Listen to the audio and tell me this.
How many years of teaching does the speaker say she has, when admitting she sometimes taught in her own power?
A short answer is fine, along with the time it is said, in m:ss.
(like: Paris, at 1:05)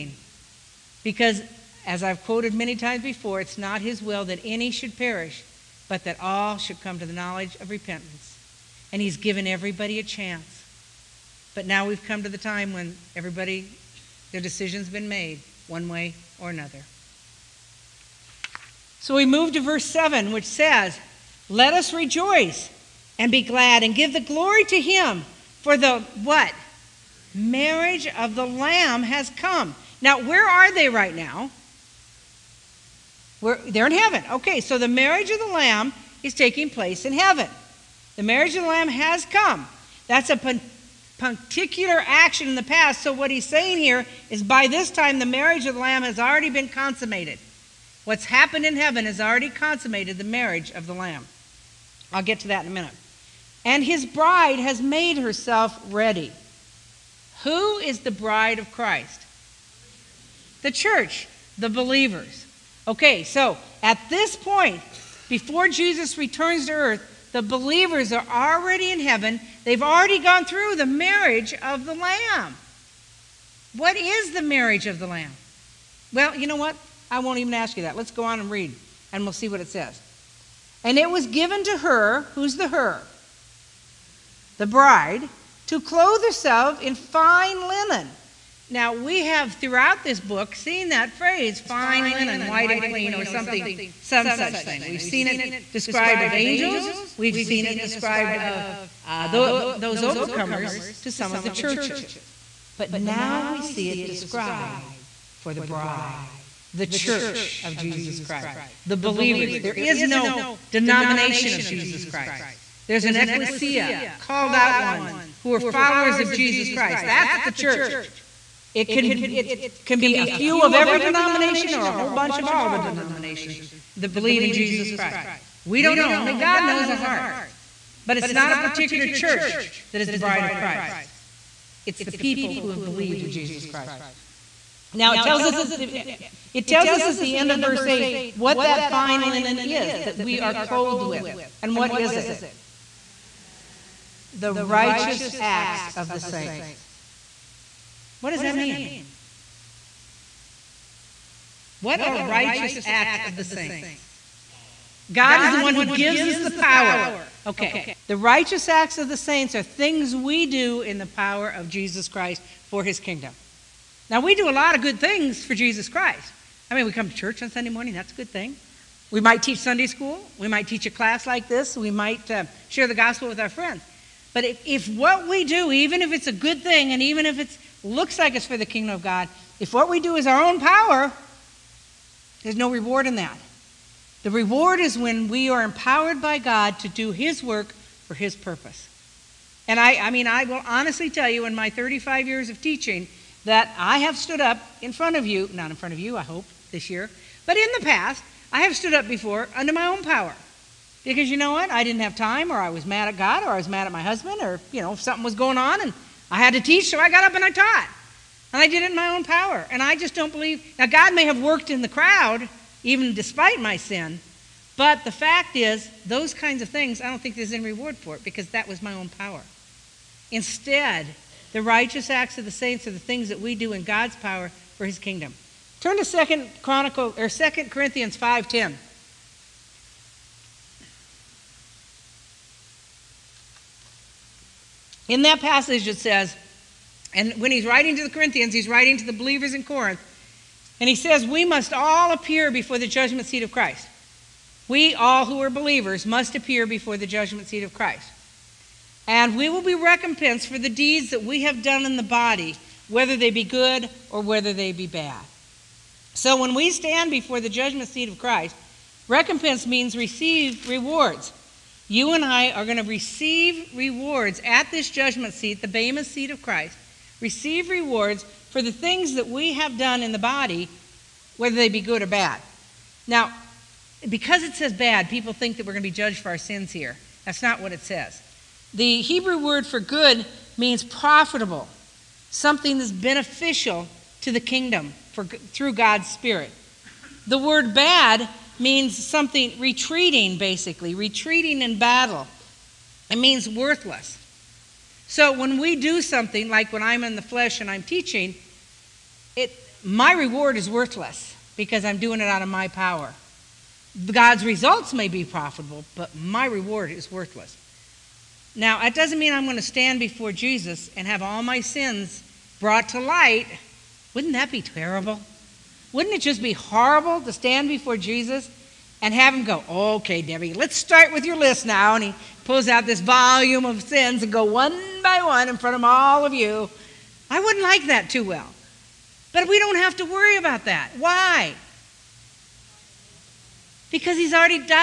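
35, at 3:11.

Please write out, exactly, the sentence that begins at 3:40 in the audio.
Instead, the righteous acts of the saints are the things that we do in God's power for his kingdom.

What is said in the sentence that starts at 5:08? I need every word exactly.
Now, that doesn't mean I'm going to stand before Jesus and have all my sins brought to light.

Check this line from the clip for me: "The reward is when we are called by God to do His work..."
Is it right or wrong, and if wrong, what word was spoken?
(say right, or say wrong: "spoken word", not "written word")
wrong: "empowered", not "called".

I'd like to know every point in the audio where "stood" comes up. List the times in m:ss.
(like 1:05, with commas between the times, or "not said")
3:14, 3:18.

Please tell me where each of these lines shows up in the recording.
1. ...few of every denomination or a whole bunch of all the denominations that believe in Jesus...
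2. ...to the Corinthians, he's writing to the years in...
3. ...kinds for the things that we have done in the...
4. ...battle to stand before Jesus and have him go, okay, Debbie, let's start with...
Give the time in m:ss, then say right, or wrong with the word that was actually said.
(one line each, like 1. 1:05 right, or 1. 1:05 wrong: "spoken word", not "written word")
1. 2:00 right
2. 3:57 wrong: "believers", not "years"
3. 4:27 wrong: "rewards", not "kinds"
4. 5:16 wrong: "horrible", not "battle".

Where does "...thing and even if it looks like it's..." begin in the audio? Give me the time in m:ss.
2:56.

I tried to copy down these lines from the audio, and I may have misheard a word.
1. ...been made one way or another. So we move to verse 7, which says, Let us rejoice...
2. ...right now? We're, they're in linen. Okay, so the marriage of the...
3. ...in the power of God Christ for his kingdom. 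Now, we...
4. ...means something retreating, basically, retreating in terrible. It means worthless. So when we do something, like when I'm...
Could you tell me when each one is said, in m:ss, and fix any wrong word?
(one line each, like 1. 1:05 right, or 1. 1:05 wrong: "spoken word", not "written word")
1. 0:14 right
2. 0:30 wrong: "heaven", not "linen"
3. 2:40 wrong: "Jesus", not "God"
4. 4:48 wrong: "battle", not "terrible".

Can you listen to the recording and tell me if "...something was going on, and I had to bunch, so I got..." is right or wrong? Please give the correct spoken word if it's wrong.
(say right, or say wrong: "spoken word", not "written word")
wrong: "teach", not "bunch".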